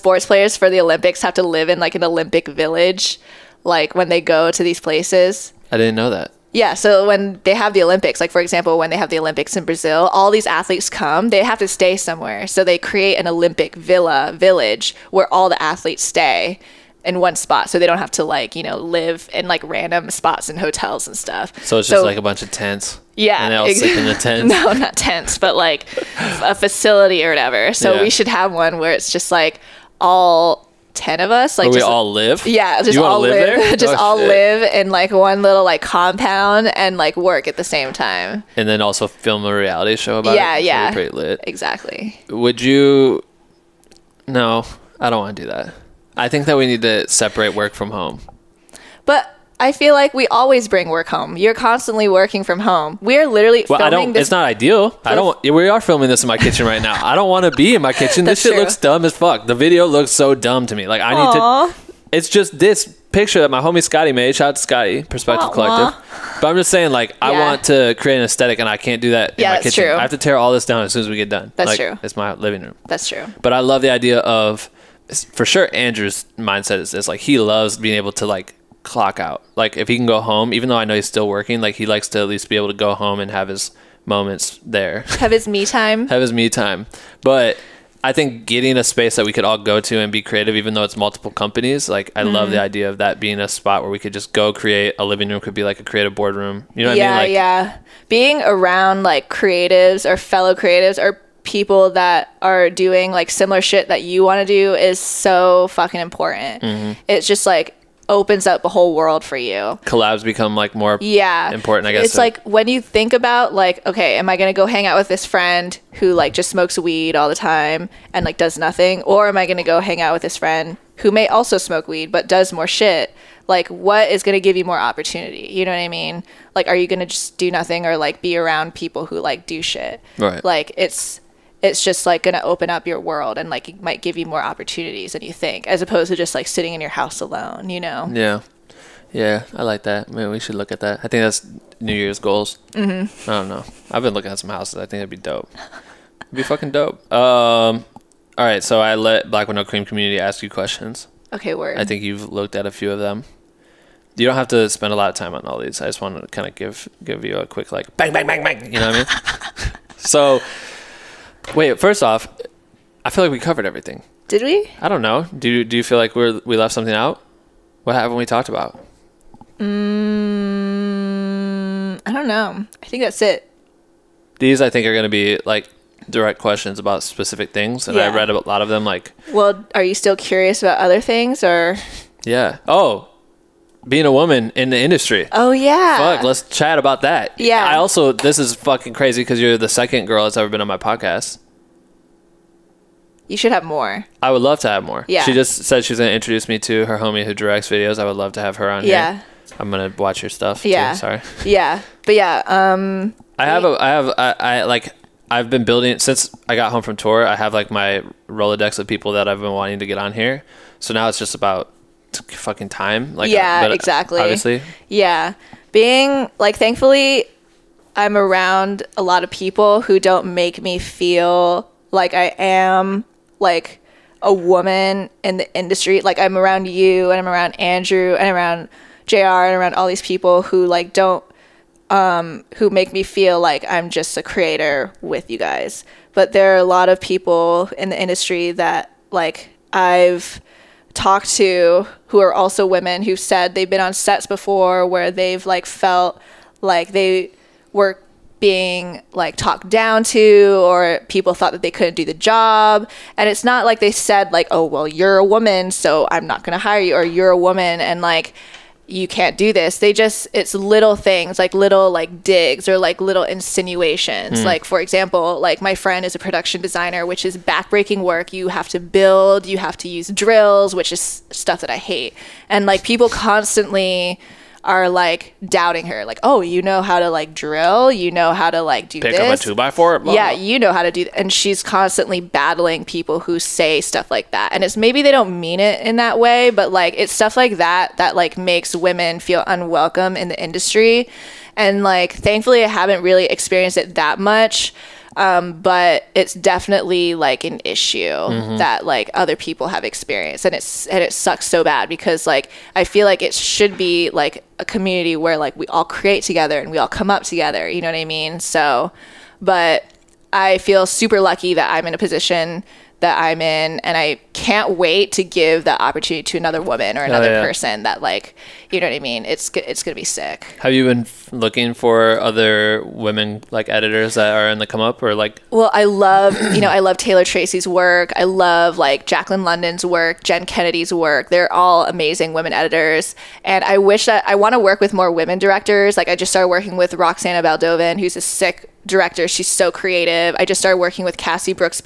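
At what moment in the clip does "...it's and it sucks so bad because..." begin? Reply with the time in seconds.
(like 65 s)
300 s.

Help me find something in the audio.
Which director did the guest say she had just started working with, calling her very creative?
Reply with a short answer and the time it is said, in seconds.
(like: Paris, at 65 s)
Roxana Baldovin, at 336 s.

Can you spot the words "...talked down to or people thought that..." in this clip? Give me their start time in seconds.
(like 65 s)
249 s.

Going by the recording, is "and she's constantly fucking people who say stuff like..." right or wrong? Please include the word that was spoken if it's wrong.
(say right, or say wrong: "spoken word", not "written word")
wrong: "battling", not "fucking".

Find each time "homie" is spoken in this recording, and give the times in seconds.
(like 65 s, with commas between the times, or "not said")
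63 s, 196 s.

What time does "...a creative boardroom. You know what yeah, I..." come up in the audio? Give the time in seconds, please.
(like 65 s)
95 s.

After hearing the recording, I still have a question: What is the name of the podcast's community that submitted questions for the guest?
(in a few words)
Black With No Cream.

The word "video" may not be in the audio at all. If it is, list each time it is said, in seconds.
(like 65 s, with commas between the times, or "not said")
59 s, 197 s.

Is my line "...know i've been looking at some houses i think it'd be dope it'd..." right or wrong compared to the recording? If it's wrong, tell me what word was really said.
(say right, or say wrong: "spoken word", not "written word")
right.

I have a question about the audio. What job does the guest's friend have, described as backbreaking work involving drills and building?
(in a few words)
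production designer.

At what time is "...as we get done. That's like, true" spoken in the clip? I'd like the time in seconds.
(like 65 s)
70 s.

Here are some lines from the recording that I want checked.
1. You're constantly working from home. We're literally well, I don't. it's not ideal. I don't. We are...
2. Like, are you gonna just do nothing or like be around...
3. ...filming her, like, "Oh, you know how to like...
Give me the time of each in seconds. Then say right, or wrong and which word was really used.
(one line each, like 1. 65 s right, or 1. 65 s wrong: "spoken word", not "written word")
1. 51 s right
2. 126 s right
3. 275 s wrong: "doubting", not "filming".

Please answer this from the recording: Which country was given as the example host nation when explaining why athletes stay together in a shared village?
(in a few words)
Brazil.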